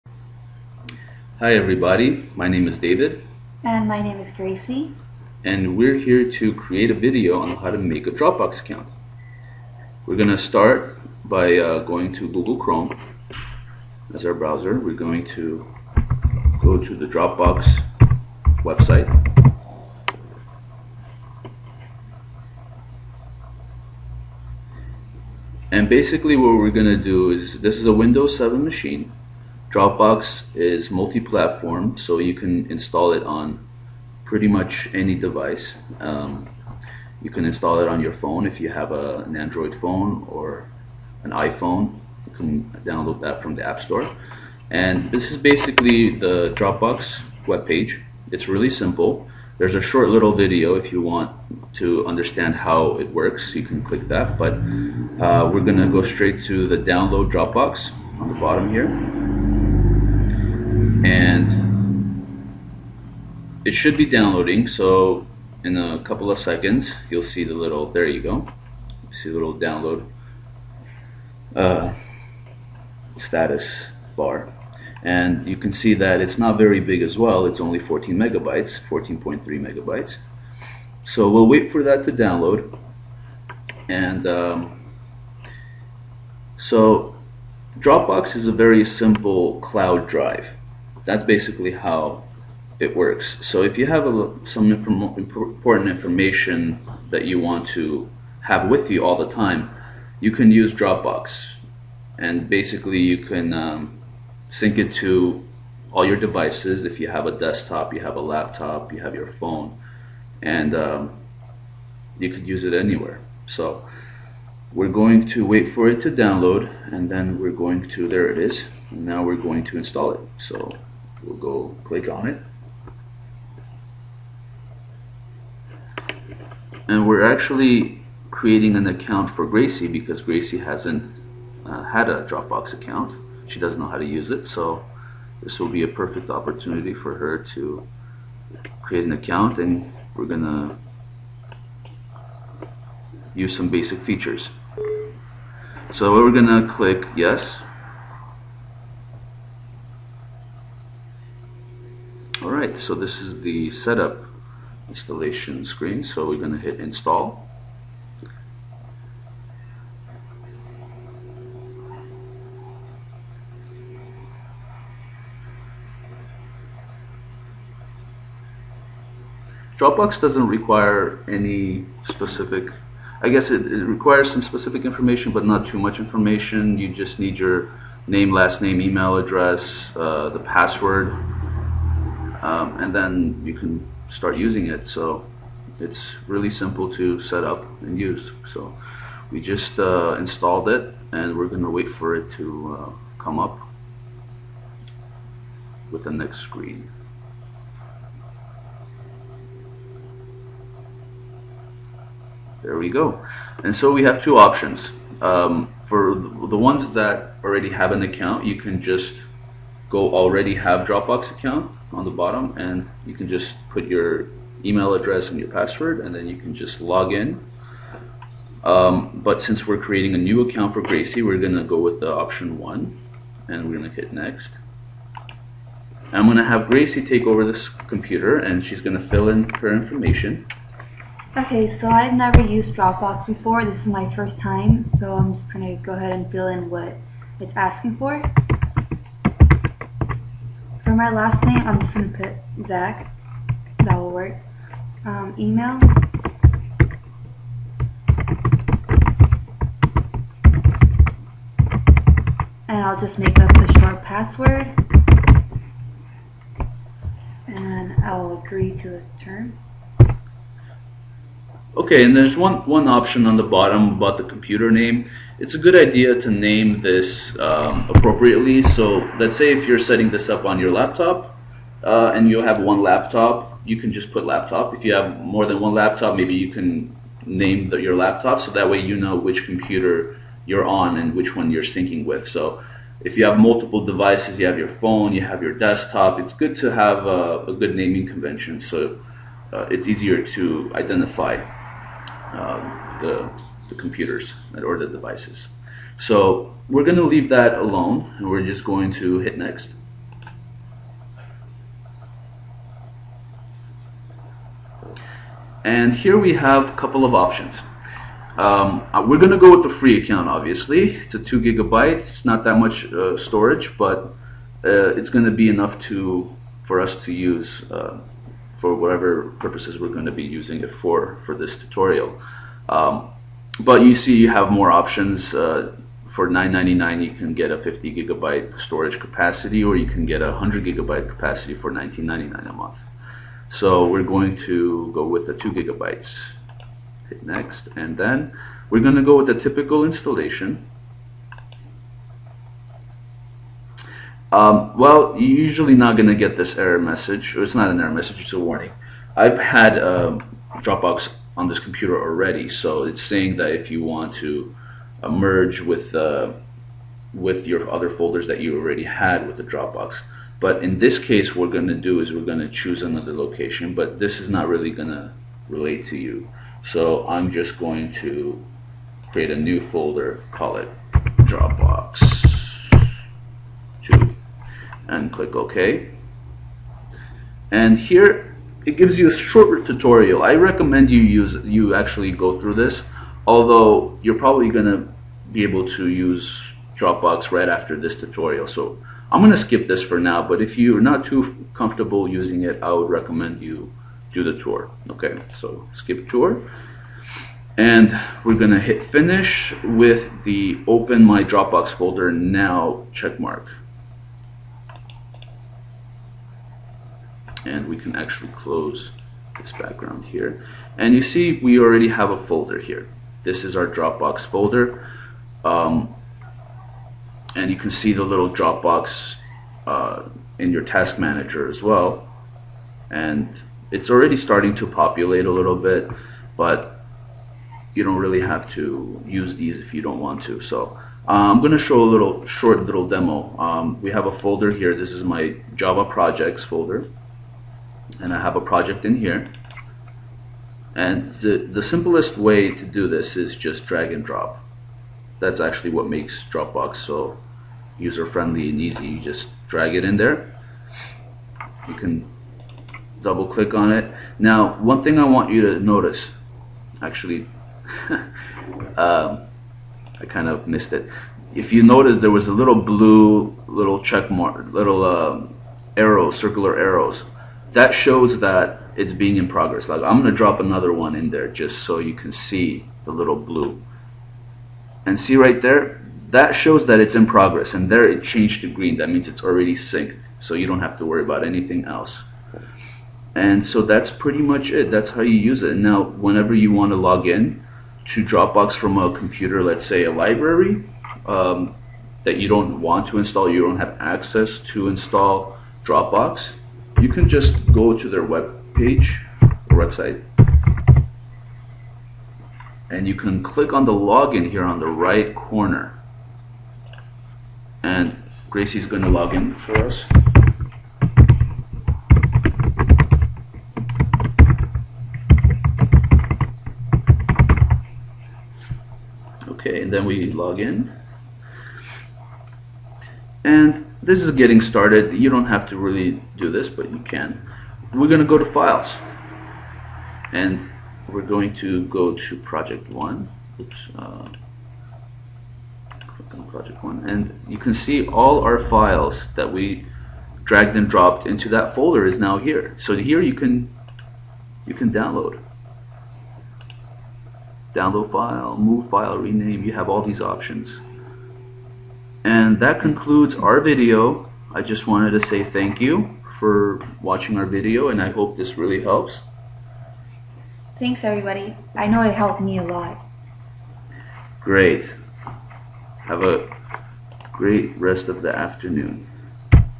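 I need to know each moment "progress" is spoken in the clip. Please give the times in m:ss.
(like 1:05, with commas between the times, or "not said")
7:49, 7:57.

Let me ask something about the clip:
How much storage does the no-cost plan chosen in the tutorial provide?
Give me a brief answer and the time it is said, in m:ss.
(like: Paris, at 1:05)
2 gigabytes, at 5:11.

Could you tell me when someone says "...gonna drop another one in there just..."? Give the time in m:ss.
7:50.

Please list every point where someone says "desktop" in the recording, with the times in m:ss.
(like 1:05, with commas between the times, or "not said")
1:47, 4:45.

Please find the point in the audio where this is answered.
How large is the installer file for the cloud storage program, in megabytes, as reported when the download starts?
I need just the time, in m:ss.
1:18.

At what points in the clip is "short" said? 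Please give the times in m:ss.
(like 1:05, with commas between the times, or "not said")
0:49, 4:13, 6:19, 7:12.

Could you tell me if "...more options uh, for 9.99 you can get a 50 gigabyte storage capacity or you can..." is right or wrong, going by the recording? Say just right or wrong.
right.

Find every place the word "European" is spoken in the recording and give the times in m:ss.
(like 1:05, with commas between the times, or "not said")
not said.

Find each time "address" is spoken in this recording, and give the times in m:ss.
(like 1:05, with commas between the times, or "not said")
2:59, 3:34.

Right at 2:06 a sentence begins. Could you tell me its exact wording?
And we're actually creating an account for Gracie because Gracie hasn't uh, had a Dropbox account.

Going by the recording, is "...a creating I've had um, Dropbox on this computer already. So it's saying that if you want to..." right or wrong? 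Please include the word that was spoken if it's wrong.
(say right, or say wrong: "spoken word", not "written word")
wrong: "warning", not "creating".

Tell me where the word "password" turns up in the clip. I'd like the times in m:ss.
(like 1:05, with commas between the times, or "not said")
3:00, 3:35, 4:14.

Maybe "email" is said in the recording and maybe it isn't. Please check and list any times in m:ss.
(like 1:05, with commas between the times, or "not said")
2:58, 3:34, 4:05.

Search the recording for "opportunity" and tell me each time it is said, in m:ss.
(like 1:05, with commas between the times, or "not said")
2:16.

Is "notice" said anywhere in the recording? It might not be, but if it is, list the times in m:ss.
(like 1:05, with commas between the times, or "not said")
7:35, 7:41.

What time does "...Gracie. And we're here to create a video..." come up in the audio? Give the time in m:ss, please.
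0:04.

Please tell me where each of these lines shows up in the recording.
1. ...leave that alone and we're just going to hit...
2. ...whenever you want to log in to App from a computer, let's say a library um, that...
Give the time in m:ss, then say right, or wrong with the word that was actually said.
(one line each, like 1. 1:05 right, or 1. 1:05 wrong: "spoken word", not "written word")
1. 4:57 right
2. 8:05 wrong: "Dropbox", not "App".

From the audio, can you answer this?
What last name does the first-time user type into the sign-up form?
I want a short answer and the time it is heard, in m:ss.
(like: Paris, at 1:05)
Zach, at 4:02.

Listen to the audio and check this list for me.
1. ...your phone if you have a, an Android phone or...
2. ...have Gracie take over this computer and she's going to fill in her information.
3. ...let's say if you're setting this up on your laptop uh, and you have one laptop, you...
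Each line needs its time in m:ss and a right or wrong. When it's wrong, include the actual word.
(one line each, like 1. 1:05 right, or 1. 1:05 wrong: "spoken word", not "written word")
1. 0:38 right
2. 3:46 right
3. 4:29 right.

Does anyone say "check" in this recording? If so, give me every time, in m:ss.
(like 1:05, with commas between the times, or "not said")
6:42, 7:43.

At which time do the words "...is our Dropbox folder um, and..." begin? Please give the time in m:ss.
6:53.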